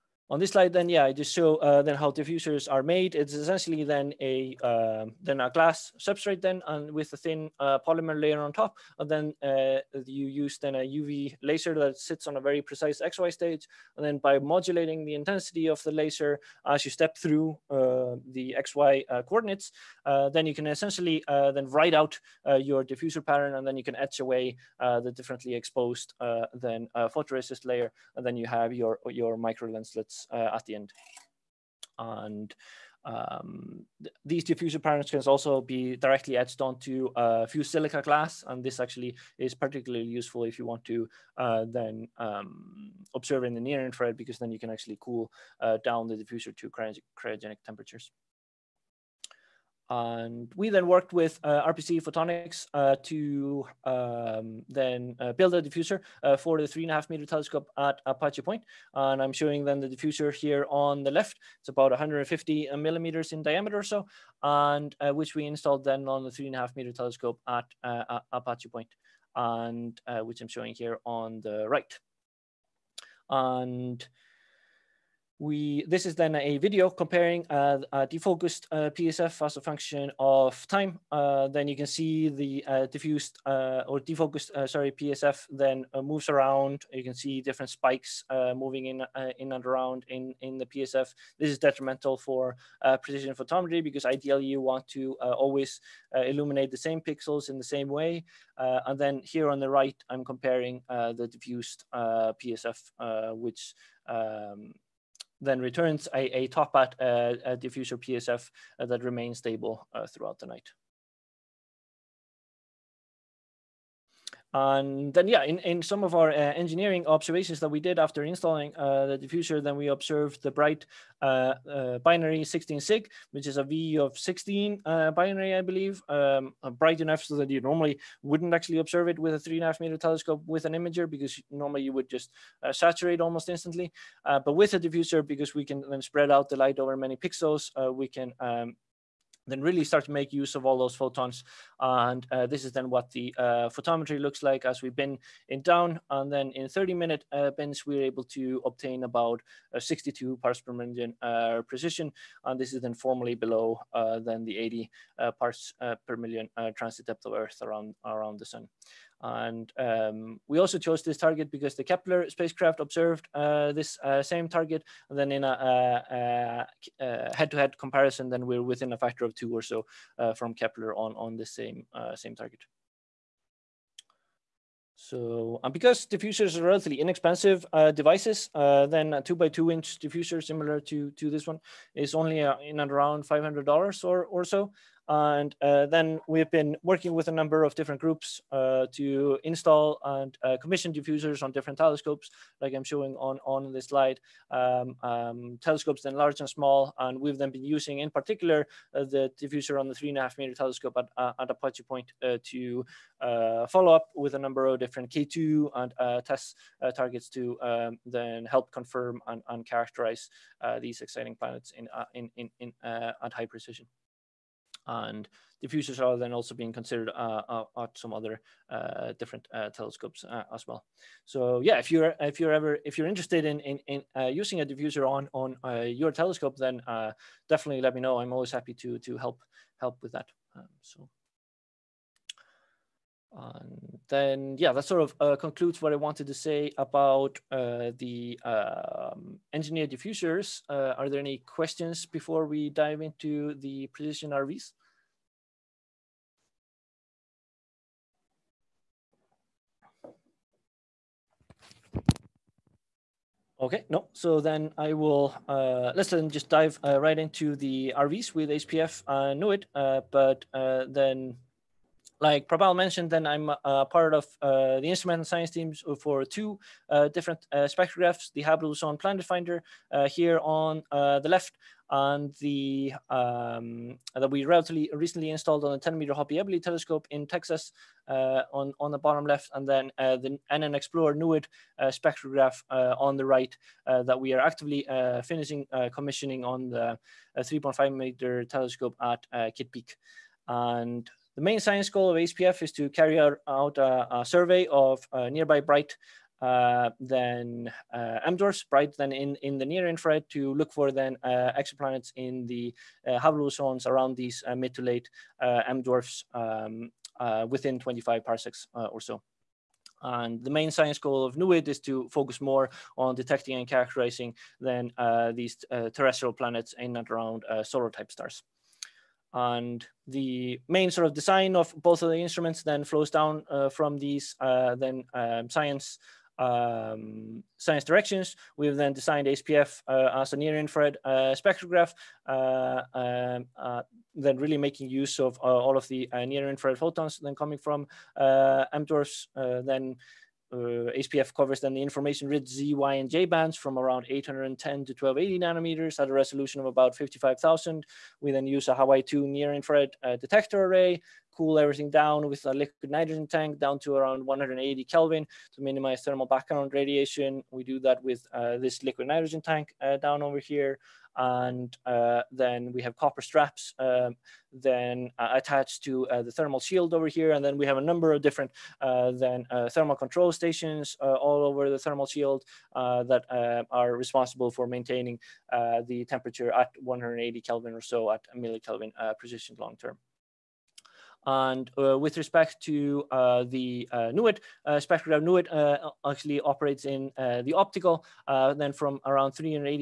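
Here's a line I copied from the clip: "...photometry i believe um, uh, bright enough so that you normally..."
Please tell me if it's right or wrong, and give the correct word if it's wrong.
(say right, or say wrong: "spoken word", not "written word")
wrong: "binary", not "photometry".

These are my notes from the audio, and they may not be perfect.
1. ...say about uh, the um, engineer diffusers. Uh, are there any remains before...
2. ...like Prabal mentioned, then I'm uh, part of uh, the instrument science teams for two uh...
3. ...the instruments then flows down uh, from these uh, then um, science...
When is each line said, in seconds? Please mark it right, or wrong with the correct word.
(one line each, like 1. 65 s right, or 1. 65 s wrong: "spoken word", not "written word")
1. 236 s wrong: "questions", not "remains"
2. 262 s right
3. 322 s right.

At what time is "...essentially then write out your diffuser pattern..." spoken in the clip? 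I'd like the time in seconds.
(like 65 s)
20 s.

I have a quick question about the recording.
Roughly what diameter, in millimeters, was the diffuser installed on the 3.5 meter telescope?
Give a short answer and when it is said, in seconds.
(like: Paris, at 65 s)
150, at 61 s.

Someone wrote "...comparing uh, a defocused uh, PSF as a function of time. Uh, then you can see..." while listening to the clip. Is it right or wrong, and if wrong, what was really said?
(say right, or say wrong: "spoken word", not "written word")
right.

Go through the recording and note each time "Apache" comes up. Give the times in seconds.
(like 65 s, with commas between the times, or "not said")
58 s, 68 s, 201 s.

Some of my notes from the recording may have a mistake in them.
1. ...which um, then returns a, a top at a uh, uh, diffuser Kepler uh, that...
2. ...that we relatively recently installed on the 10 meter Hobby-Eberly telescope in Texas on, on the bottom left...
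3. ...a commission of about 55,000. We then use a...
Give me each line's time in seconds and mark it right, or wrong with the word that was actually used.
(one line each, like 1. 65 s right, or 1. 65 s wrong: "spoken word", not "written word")
1. 103 s wrong: "PSF", not "Kepler"
2. 274 s right
3. 346 s wrong: "resolution", not "commission".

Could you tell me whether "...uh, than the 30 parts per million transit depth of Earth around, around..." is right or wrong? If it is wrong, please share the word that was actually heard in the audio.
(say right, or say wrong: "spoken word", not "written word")
wrong: "80", not "30".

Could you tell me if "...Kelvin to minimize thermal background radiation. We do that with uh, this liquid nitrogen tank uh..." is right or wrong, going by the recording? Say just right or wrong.
right.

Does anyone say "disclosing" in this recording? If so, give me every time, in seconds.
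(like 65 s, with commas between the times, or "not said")
not said.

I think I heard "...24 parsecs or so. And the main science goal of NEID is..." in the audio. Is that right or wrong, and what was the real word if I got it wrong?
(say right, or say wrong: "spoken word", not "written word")
wrong: "25", not "24".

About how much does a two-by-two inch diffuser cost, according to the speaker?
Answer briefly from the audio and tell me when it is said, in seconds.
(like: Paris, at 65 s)
$500, at 183 s.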